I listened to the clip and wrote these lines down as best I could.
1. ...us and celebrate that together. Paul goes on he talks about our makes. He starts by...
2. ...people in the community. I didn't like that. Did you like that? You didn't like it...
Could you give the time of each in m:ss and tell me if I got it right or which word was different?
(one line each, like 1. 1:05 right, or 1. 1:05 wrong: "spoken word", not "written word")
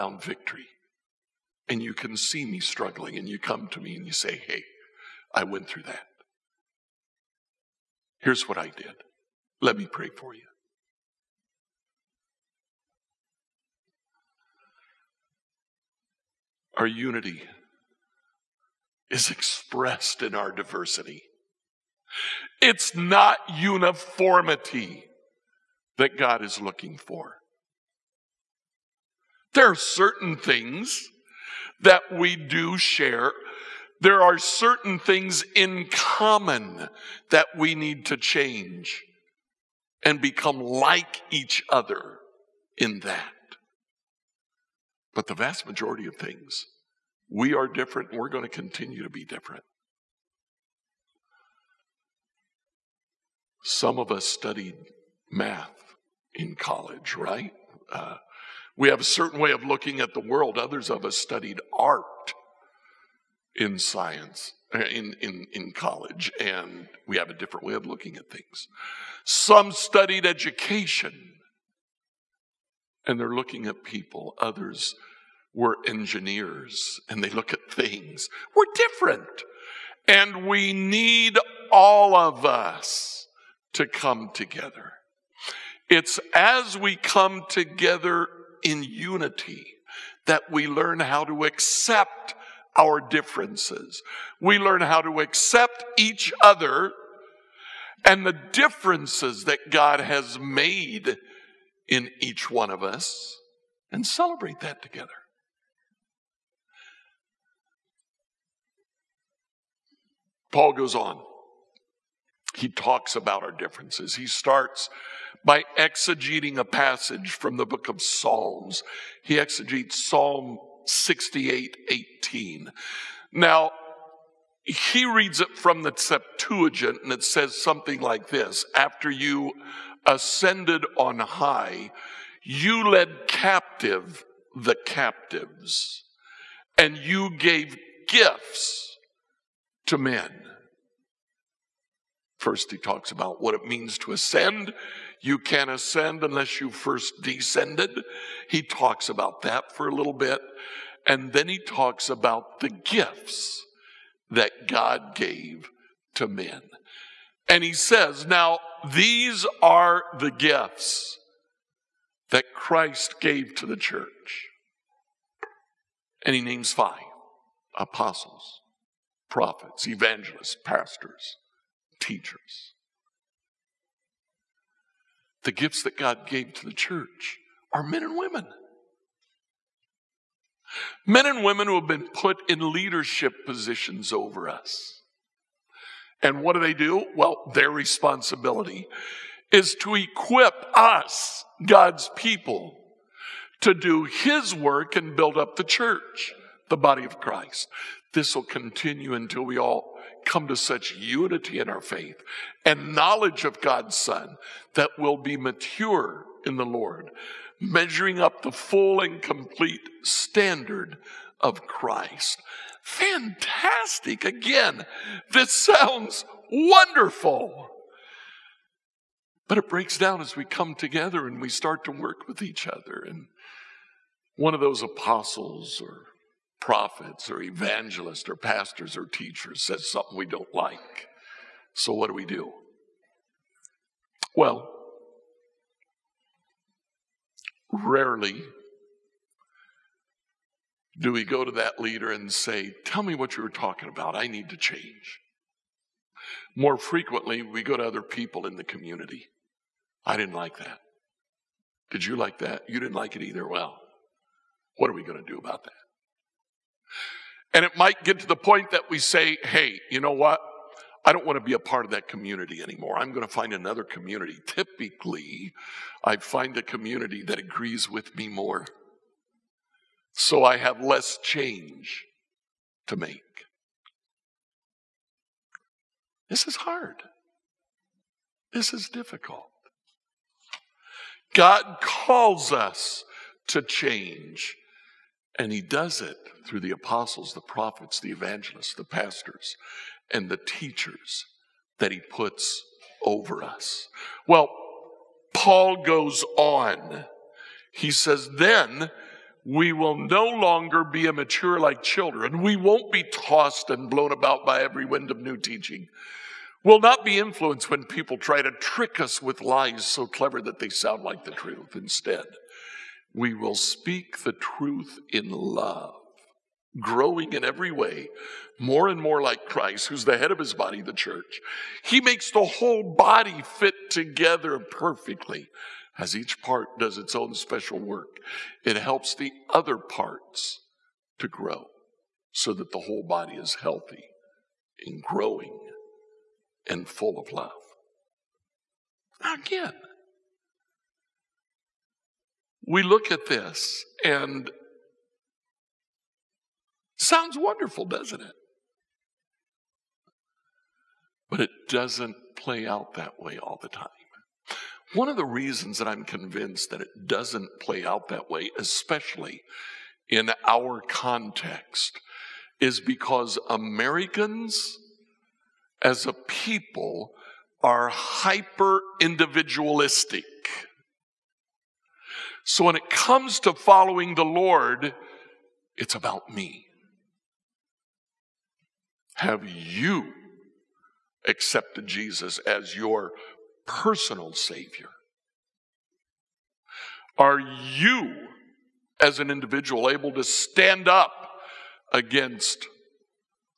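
1. 1:42 wrong: "differences", not "makes"
2. 4:08 right.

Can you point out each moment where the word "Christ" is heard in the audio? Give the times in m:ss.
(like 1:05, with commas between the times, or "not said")
2:42, 3:17, 3:31, 5:19.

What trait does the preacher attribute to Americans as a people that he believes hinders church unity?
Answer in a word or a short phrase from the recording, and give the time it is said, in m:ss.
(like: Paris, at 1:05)
Hyper individualistic, at 6:07.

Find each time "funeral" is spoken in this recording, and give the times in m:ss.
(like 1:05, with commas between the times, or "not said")
not said.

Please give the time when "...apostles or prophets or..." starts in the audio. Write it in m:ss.
3:44.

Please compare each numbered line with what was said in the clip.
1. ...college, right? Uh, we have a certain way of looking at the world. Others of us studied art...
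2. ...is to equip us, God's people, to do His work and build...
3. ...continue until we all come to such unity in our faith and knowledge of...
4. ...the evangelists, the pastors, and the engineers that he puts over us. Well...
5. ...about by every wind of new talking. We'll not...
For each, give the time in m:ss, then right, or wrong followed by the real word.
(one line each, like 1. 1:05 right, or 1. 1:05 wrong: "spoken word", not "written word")
1. 0:56 right
2. 3:09 right
3. 3:18 right
4. 4:47 wrong: "teachers", not "engineers"
5. 5:04 wrong: "teaching", not "talking".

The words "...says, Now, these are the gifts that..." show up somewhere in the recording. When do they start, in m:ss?
2:37.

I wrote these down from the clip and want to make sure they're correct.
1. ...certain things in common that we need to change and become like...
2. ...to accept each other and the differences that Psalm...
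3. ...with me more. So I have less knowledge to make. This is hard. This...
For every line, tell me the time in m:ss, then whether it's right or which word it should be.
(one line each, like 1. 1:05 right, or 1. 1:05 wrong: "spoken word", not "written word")
1. 0:34 right
2. 1:35 wrong: "God", not "Psalm"
3. 4:27 wrong: "change", not "knowledge".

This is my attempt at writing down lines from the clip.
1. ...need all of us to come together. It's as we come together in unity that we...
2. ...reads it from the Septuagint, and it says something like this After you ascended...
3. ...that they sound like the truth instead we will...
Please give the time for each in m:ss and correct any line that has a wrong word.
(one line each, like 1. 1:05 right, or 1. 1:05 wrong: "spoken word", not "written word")
1. 1:20 right
2. 2:05 right
3. 5:10 right.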